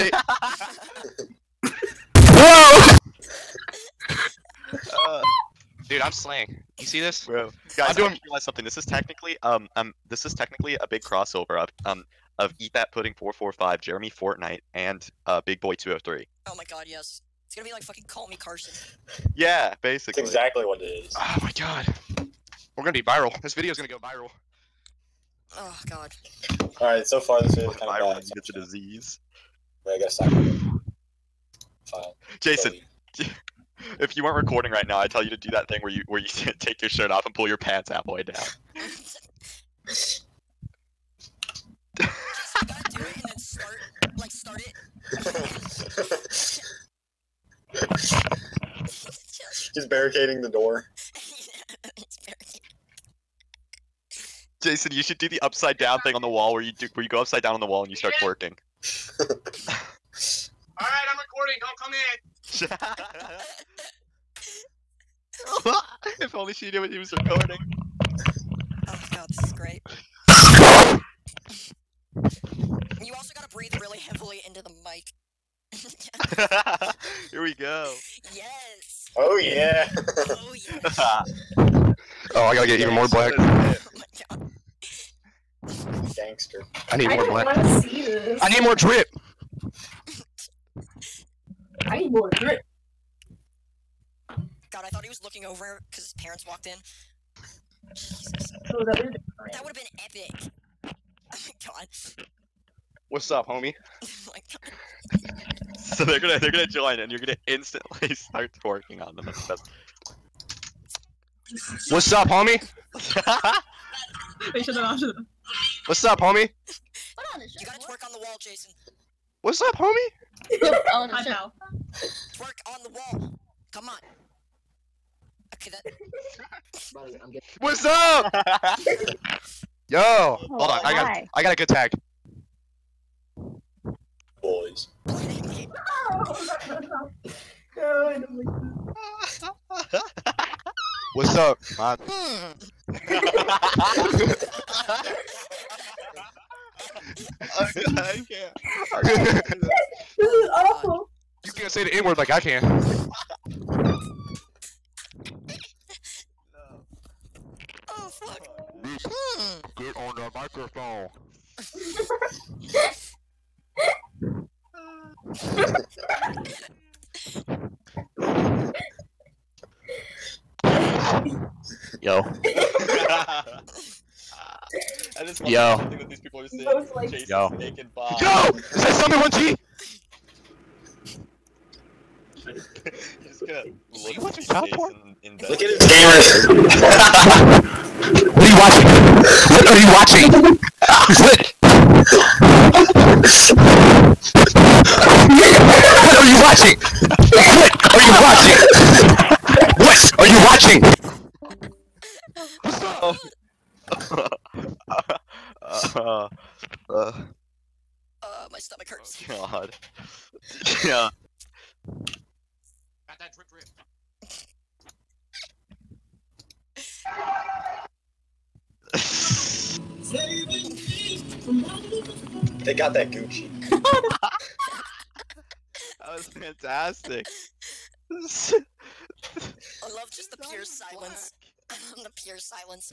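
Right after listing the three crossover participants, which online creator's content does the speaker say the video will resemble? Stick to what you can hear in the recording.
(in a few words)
CallMeCarson.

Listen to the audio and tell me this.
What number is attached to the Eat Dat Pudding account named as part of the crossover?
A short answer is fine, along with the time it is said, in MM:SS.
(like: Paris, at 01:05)
445, at 00:13.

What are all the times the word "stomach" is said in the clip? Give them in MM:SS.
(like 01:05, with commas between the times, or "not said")
03:28.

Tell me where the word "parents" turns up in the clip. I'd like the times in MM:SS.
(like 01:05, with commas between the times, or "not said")
01:36.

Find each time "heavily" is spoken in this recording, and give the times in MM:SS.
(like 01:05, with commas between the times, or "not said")
01:13.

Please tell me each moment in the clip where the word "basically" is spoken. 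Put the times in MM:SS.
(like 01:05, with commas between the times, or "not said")
00:19.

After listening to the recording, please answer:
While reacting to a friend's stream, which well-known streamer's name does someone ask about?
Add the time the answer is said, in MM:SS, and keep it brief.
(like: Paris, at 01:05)
Summit1G, at 02:58.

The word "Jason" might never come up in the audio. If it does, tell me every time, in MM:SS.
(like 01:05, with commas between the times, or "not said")
00:32, 00:39, 00:54, 01:58.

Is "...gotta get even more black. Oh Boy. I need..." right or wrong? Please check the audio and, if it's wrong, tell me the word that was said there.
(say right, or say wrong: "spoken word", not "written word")
wrong: "Gangster", not "Boy".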